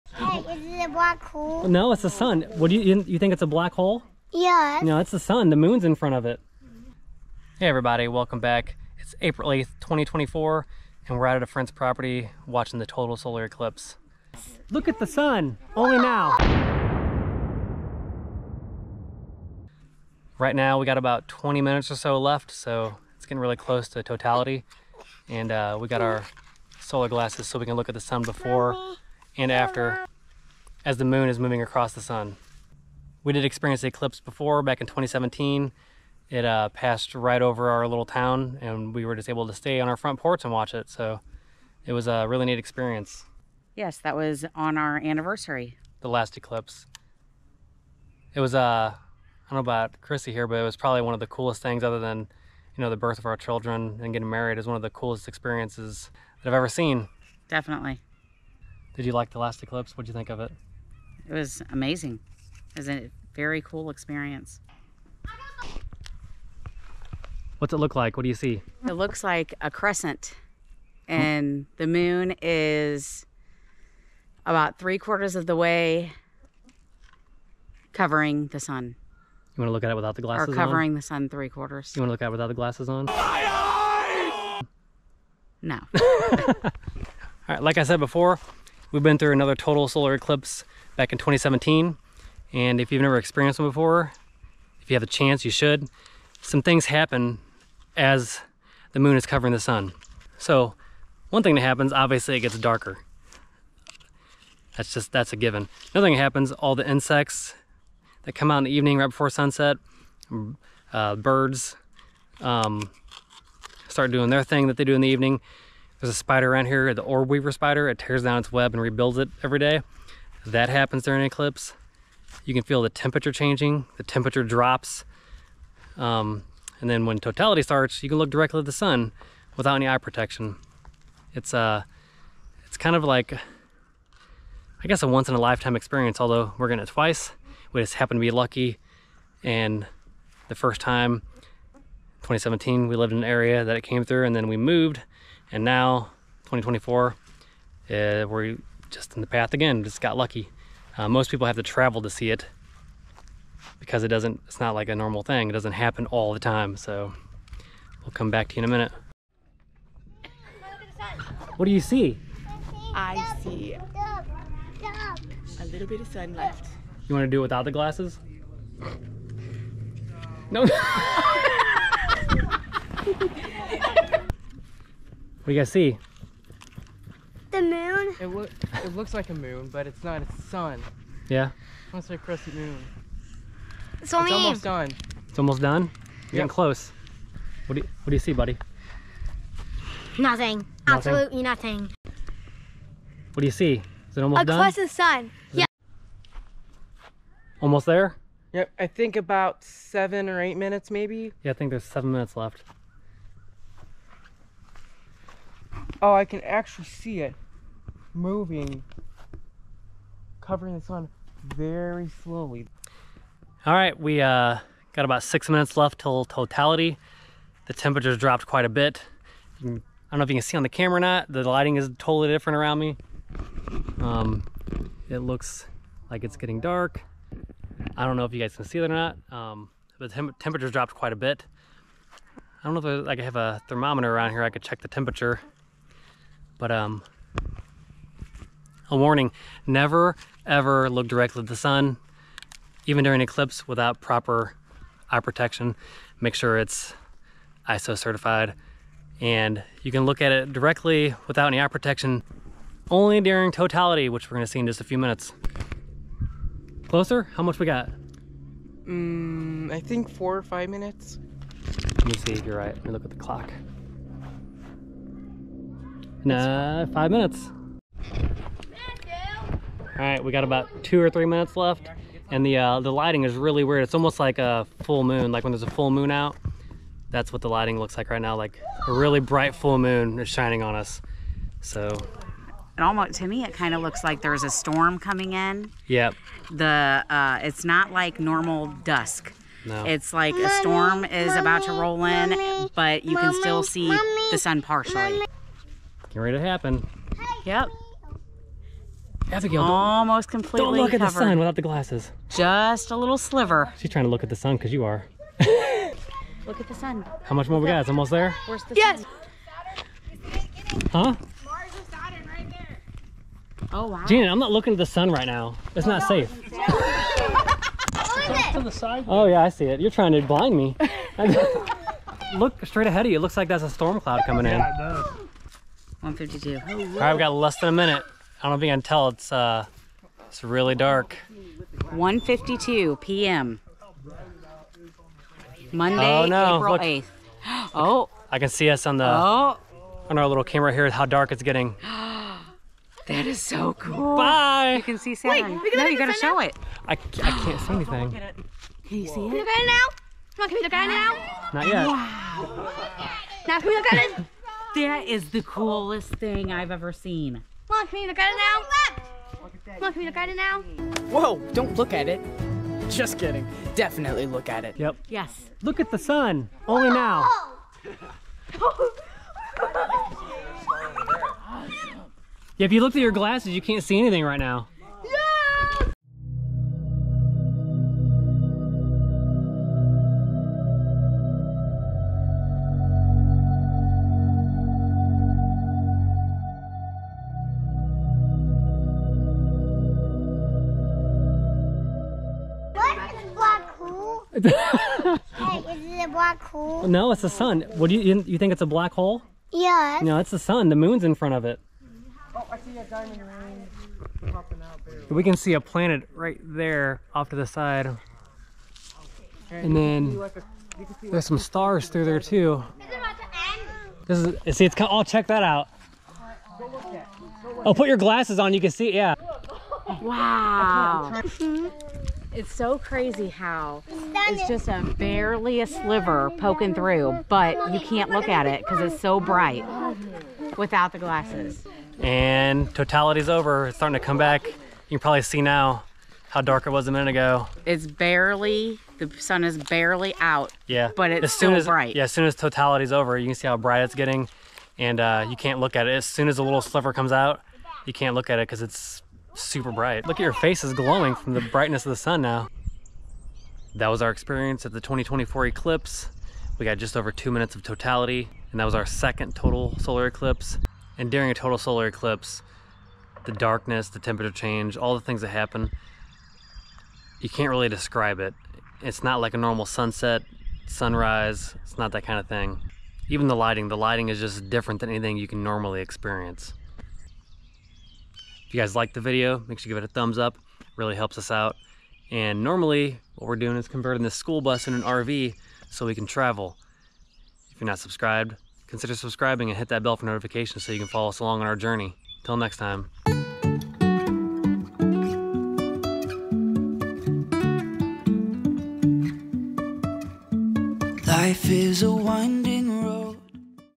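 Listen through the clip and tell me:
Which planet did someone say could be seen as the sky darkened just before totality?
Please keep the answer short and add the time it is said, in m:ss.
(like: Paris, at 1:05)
Saturn, at 5:45.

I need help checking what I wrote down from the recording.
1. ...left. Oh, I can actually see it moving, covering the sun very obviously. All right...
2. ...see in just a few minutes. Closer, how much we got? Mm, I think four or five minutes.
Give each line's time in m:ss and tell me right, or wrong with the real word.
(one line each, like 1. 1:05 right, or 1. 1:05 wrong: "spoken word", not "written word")
1. 3:22 wrong: "slowly", not "obviously"
2. 4:14 right.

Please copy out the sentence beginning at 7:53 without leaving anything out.
Even the lighting, the lighting is just different than anything you can normally experience.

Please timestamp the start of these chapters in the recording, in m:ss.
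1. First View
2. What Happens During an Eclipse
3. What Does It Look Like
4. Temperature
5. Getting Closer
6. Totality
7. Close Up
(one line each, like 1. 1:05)
1. 0:43
2. 1:30
3. 3:03
4. 3:50
5. 4:16
6. 5:25
7. 6:15.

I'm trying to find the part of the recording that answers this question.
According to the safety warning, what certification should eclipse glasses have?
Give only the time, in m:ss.
4:07.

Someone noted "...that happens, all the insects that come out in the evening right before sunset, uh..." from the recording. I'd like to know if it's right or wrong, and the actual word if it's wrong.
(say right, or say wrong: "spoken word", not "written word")
right.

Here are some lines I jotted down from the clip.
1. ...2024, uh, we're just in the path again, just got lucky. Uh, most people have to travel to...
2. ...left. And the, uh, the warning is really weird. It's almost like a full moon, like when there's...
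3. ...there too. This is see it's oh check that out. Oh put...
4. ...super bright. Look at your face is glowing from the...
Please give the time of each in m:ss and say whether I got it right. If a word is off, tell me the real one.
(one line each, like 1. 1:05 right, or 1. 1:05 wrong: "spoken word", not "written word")
1. 2:26 right
2. 4:31 wrong: "lighting", not "warning"
3. 6:52 right
4. 7:29 right.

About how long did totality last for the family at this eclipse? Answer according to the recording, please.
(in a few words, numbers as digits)
just over two minutes.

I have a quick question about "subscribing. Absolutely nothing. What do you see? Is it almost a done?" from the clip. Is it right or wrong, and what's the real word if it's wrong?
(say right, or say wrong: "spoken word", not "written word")
wrong: "nothing", not "subscribing".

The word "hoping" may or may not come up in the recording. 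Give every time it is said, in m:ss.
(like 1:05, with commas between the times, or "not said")
not said.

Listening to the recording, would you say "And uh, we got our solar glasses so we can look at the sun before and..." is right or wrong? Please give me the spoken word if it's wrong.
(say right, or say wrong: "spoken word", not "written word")
right.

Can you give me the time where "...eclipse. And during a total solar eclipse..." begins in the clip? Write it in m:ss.
7:40.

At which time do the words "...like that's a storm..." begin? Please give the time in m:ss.
5:23.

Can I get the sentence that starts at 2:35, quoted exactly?
It doesn't happen all the time.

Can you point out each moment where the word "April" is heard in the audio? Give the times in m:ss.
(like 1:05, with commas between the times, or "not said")
0:09, 5:36.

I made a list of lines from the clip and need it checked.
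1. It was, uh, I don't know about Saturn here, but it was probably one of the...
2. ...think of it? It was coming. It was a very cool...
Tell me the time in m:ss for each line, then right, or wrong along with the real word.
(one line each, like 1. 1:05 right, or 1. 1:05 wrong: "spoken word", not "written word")
1. 0:48 wrong: "Chrissy", not "Saturn"
2. 1:00 wrong: "amazing", not "coming".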